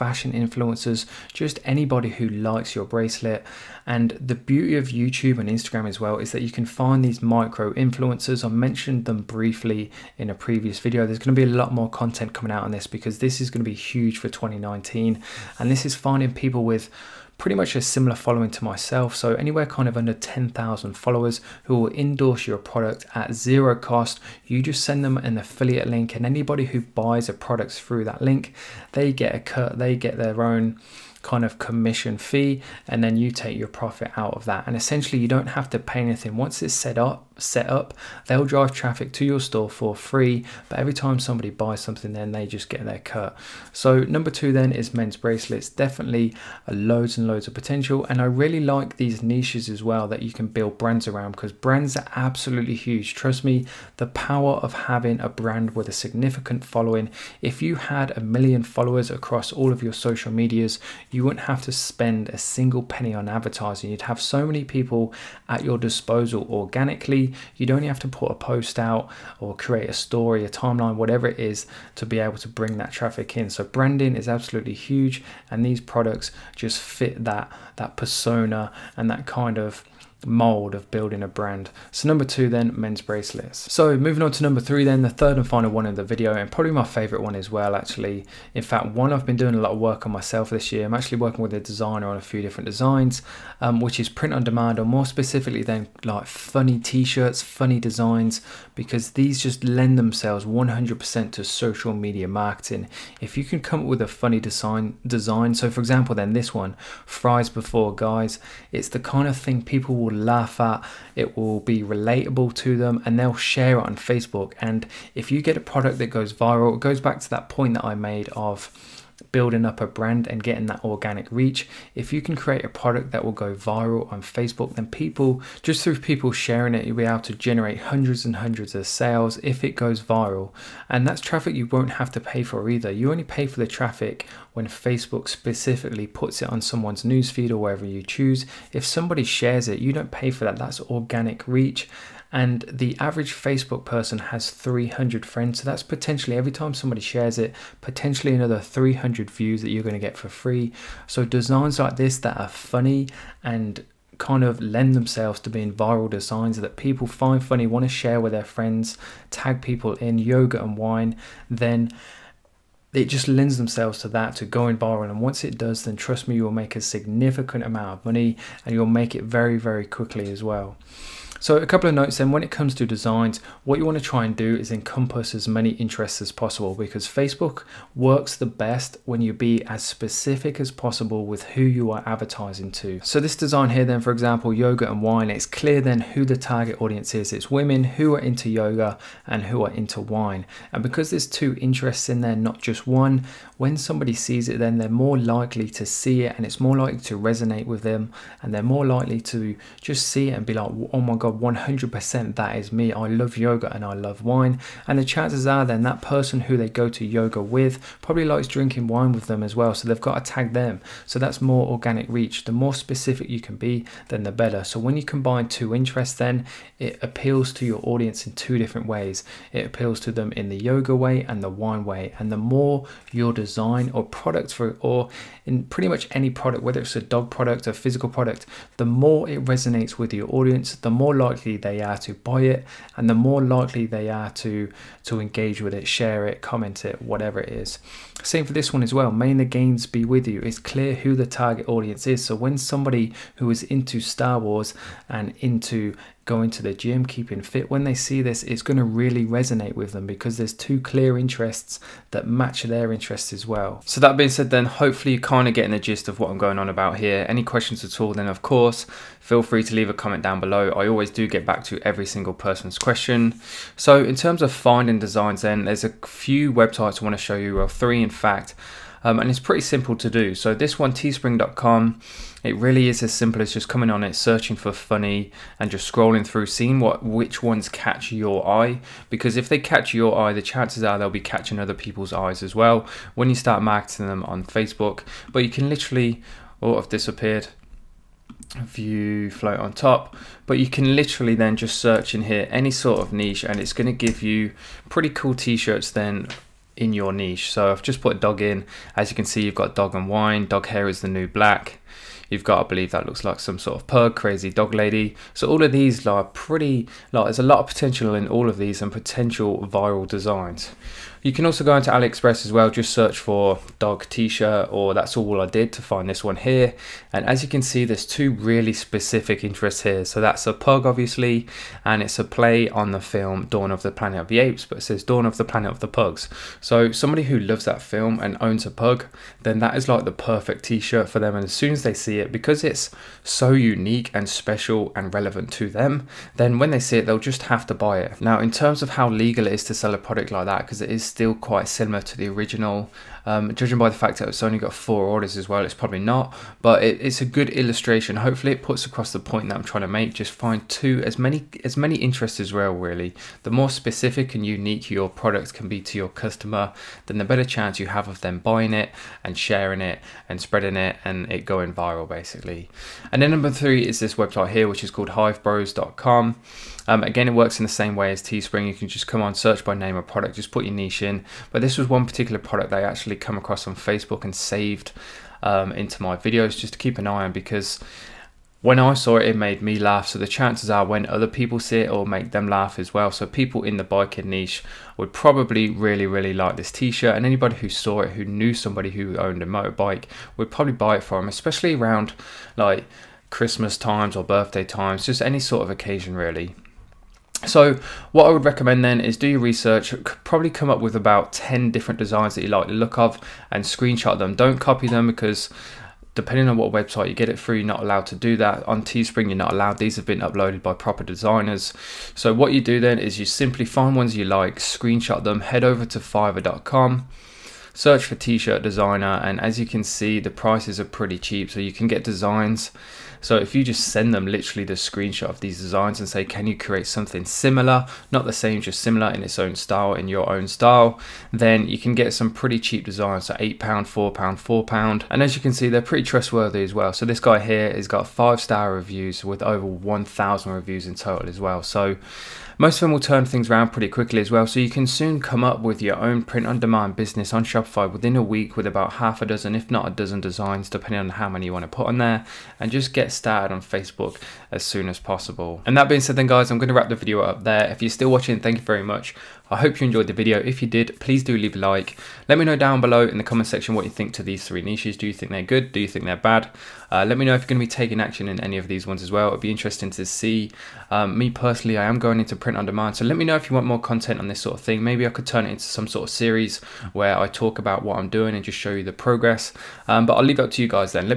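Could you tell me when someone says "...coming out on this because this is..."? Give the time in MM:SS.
00:12.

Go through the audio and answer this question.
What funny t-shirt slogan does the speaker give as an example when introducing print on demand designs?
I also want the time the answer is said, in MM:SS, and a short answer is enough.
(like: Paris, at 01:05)
Fries before guys, at 01:47.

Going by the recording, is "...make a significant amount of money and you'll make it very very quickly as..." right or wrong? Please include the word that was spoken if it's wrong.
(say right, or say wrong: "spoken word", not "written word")
right.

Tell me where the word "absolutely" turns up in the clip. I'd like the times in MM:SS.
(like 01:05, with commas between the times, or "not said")
00:52, 01:14.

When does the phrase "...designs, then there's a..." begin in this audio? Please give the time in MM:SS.
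04:24.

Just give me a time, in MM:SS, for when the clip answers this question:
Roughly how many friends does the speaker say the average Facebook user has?
02:24.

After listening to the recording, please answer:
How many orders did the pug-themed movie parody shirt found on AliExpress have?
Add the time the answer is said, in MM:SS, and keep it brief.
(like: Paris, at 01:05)
4, at 05:44.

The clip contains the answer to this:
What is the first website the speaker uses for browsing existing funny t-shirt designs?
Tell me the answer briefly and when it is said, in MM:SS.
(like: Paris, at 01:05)
teespring.com, at 04:30.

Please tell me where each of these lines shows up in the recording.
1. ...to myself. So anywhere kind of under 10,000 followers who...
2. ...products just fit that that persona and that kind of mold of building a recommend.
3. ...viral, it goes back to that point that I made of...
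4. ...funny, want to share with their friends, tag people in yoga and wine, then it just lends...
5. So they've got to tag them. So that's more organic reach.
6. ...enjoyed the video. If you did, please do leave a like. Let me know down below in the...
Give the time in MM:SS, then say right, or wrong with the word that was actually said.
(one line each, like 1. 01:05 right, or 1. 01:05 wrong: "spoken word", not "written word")
1. 00:18 right
2. 01:15 wrong: "brand", not "recommend"
3. 01:56 right
4. 02:37 right
5. 03:29 right
6. 07:39 right.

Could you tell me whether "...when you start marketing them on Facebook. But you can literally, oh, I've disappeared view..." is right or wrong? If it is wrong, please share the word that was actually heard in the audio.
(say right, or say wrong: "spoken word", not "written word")
right.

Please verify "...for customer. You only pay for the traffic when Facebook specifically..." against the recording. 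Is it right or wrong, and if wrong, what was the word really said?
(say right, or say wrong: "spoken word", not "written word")
wrong: "either", not "customer".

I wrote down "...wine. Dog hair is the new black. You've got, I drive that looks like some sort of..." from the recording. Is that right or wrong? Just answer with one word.
wrong.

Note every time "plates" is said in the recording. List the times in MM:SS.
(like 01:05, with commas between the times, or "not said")
not said.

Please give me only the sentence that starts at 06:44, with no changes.
Don't copy them because depending on what website you get it through, you're not allowed to do that.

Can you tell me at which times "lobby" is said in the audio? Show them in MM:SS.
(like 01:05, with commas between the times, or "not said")
not said.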